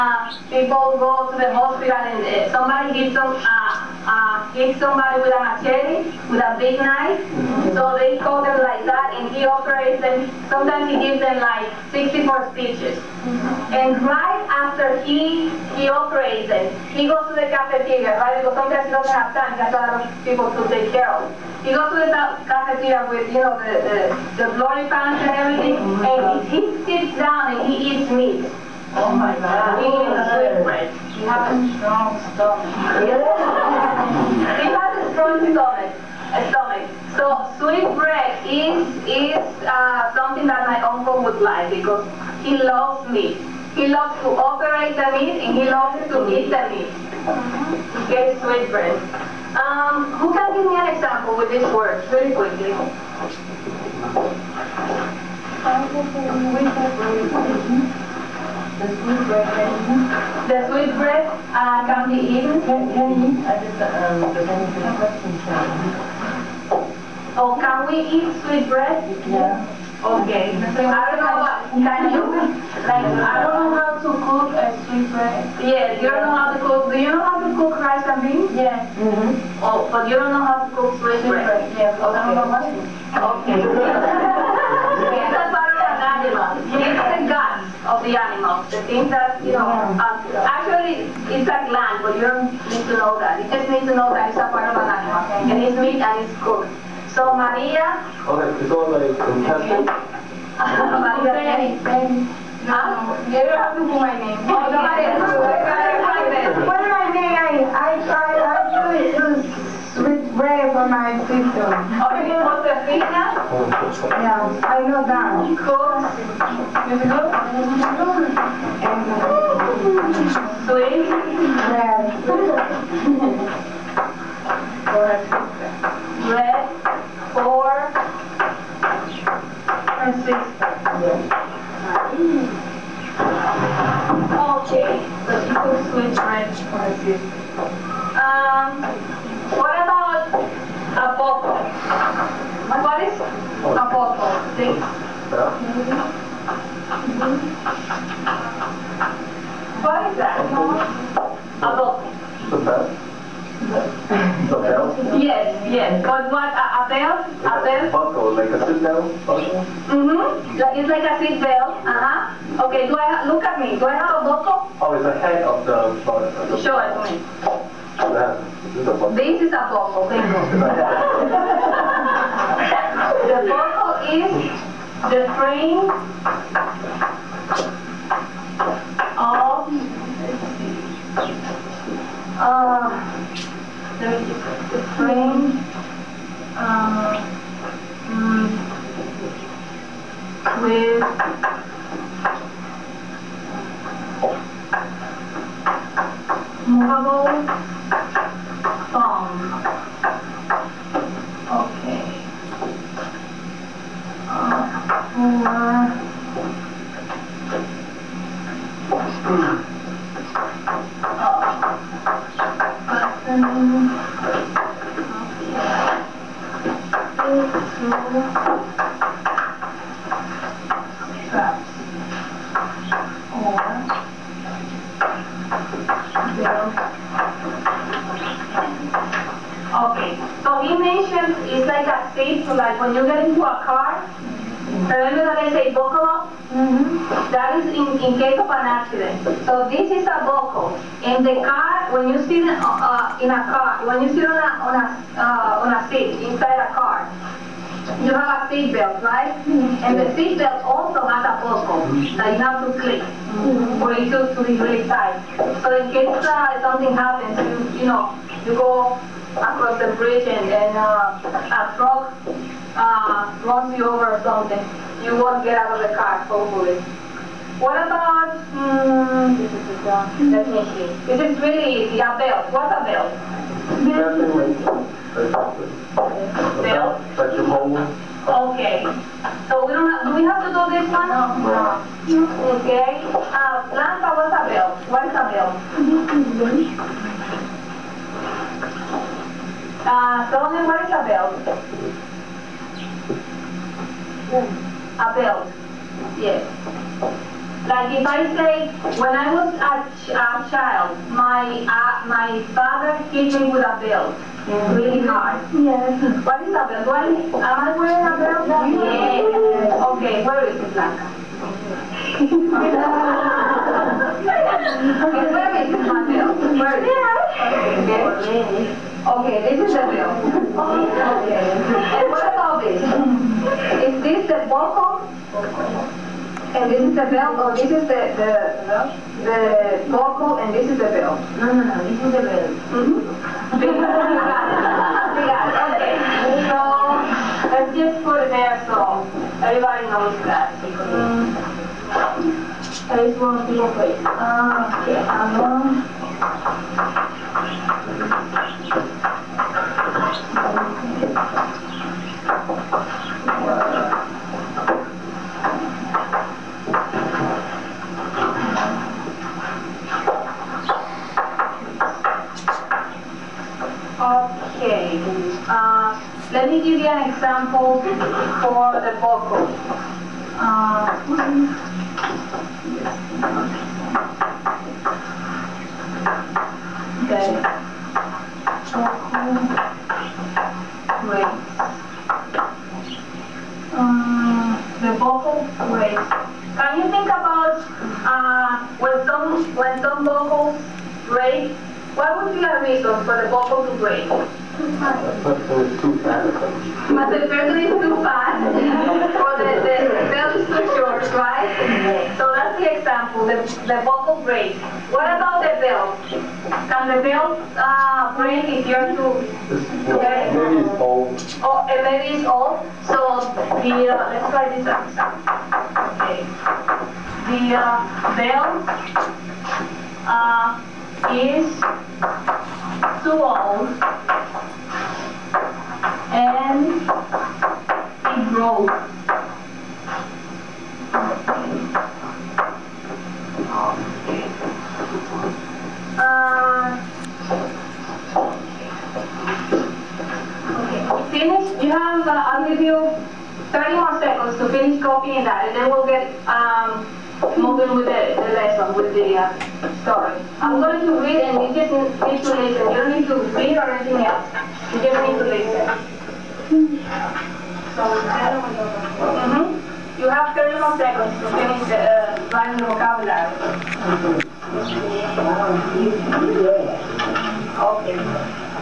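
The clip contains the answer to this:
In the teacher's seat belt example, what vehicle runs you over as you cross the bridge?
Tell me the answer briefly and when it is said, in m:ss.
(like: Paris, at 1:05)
a truck, at 4:21.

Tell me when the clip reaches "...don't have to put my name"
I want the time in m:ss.
1:43.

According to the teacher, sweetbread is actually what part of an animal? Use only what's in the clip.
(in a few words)
gland.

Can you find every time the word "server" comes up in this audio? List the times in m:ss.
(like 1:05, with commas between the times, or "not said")
not said.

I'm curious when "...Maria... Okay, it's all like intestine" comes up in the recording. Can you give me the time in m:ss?
1:37.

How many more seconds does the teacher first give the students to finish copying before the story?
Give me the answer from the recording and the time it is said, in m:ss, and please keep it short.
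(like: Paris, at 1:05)
30, at 7:23.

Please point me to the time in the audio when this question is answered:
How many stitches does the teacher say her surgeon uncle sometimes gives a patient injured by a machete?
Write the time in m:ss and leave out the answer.
0:11.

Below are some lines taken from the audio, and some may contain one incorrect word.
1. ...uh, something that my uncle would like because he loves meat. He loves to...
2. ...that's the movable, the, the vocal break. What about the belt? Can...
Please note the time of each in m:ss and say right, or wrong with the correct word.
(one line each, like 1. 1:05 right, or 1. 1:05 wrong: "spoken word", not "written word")
1. 0:39 right
2. 6:42 wrong: "example", not "movable".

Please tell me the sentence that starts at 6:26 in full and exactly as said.
Can you think about uh, when some when some vocals break?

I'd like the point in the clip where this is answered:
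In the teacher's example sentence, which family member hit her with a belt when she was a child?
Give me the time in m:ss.
5:02.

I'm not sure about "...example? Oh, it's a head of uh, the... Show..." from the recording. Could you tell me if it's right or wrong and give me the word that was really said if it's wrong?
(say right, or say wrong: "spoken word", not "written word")
wrong: "buckle", not "example".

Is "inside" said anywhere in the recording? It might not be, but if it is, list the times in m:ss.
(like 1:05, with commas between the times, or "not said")
4:06.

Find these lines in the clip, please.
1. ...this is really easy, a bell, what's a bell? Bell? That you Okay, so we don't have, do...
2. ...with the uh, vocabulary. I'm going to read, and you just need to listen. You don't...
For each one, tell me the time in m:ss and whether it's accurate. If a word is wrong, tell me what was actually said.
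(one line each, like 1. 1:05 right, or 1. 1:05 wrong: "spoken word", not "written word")
1. 4:31 right
2. 7:28 wrong: "story", not "vocabulary".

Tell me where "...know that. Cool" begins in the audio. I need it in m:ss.
1:54.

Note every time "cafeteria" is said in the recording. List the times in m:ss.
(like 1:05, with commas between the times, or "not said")
0:17, 0:22.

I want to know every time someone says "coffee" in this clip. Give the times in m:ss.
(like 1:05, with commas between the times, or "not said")
not said.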